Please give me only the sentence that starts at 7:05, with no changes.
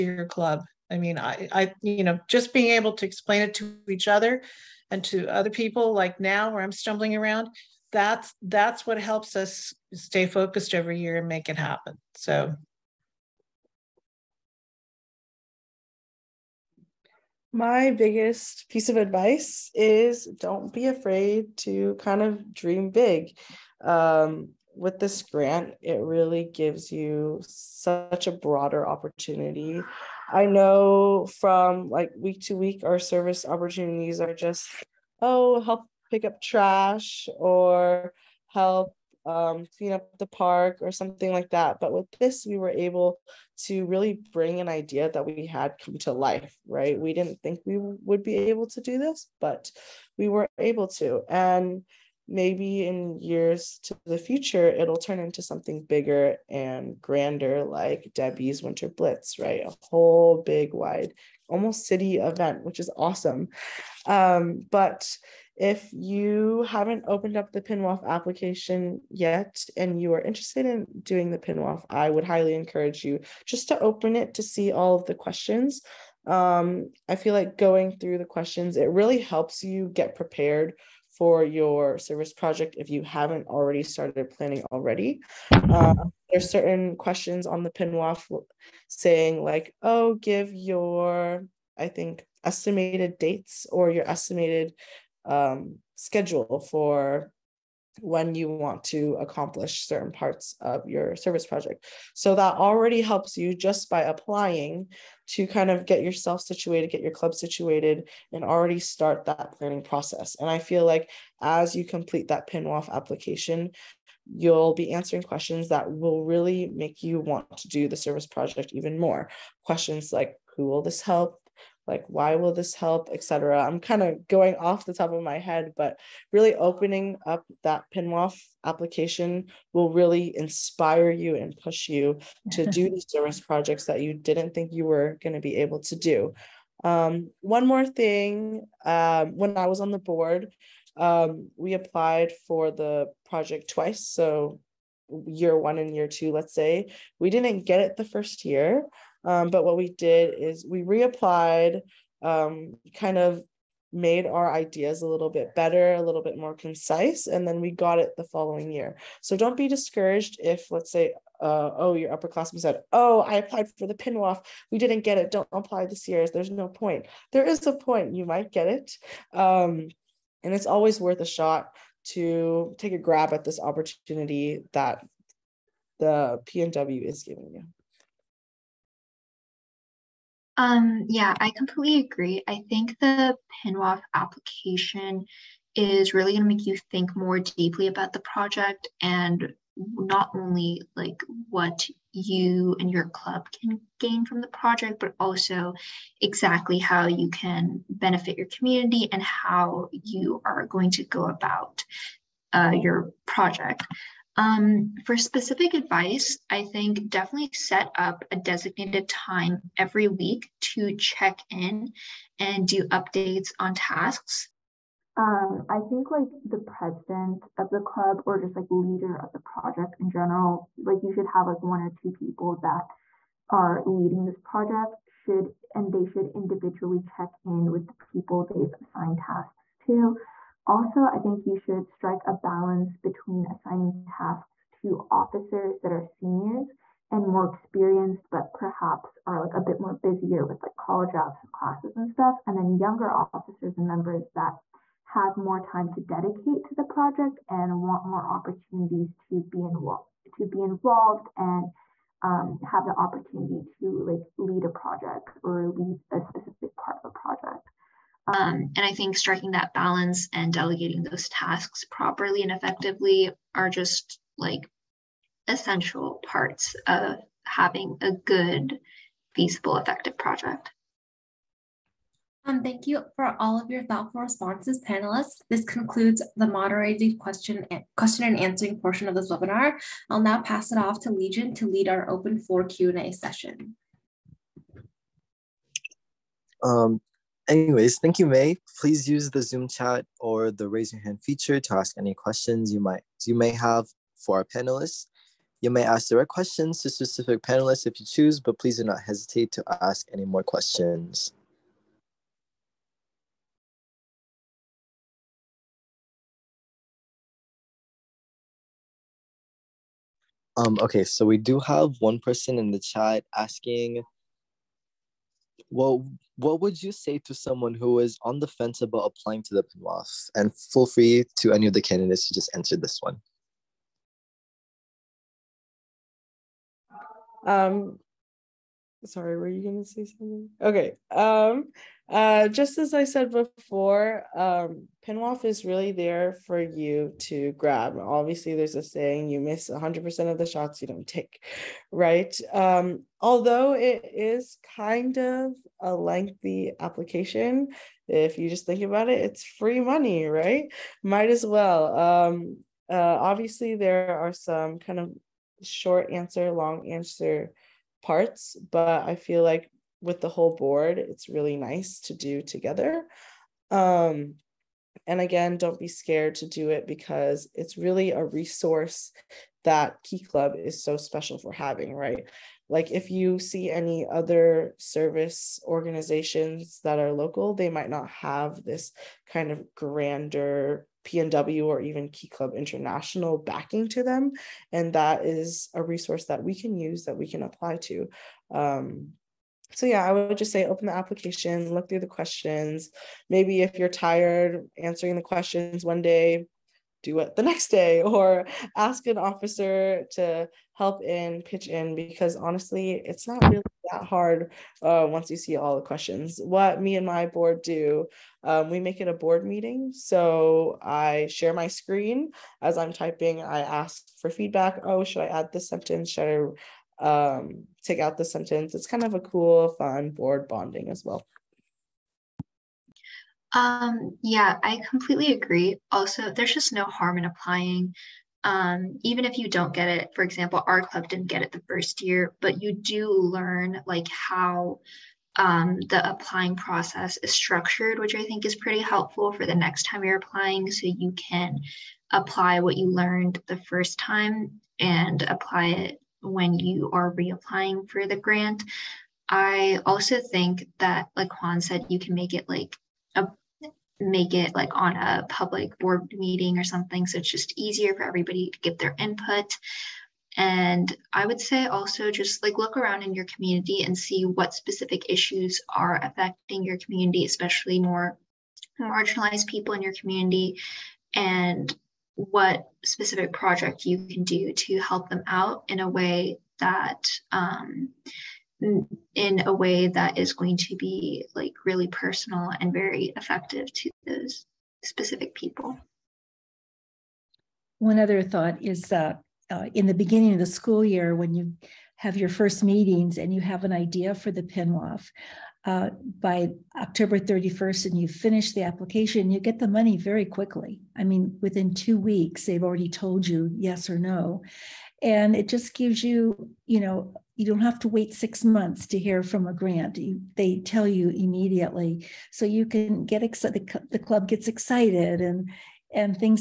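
Also, there's just no harm in applying.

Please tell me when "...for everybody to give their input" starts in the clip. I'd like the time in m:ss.
7:37.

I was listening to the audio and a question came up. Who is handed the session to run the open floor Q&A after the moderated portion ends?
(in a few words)
Legion.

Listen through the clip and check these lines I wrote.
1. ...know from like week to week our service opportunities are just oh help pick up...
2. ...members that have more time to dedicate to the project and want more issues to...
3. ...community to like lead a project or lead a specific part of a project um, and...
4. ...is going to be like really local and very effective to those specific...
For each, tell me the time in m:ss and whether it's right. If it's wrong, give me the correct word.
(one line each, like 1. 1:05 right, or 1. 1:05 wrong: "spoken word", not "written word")
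1. 0:30 right
2. 4:03 wrong: "opportunities", not "issues"
3. 4:12 wrong: "opportunity", not "community"
4. 8:00 wrong: "personal", not "local".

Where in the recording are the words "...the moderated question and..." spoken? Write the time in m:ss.
4:36.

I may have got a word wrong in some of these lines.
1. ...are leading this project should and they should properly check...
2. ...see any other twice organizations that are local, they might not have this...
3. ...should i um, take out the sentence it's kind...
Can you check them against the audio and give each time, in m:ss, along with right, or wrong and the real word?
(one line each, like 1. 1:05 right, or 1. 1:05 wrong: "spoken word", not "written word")
1. 3:43 wrong: "individually", not "properly"
2. 6:13 wrong: "service", not "twice"
3. 6:56 right.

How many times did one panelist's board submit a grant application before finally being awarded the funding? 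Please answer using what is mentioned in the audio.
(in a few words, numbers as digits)
twice.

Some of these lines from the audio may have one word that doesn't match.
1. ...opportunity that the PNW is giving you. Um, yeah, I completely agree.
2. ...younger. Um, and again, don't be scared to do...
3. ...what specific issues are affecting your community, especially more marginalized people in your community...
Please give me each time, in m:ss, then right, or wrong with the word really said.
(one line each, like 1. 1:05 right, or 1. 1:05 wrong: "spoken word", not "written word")
1. 2:53 right
2. 6:02 wrong: "together", not "younger"
3. 7:44 right.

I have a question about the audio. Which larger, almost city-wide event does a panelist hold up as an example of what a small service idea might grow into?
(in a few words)
Debbie's Winter Blitz.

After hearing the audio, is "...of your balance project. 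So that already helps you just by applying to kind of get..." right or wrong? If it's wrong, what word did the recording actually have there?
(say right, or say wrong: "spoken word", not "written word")
wrong: "service", not "balance".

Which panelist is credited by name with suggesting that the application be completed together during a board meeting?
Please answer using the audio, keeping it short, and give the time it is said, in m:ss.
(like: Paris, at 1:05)
Juan, at 7:31.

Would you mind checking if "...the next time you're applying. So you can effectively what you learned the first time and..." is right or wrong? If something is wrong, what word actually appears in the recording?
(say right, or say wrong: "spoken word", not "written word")
wrong: "apply", not "effectively".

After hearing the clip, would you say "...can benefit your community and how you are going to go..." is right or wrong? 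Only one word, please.
right.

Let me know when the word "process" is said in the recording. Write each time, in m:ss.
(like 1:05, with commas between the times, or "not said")
1:49, 7:16.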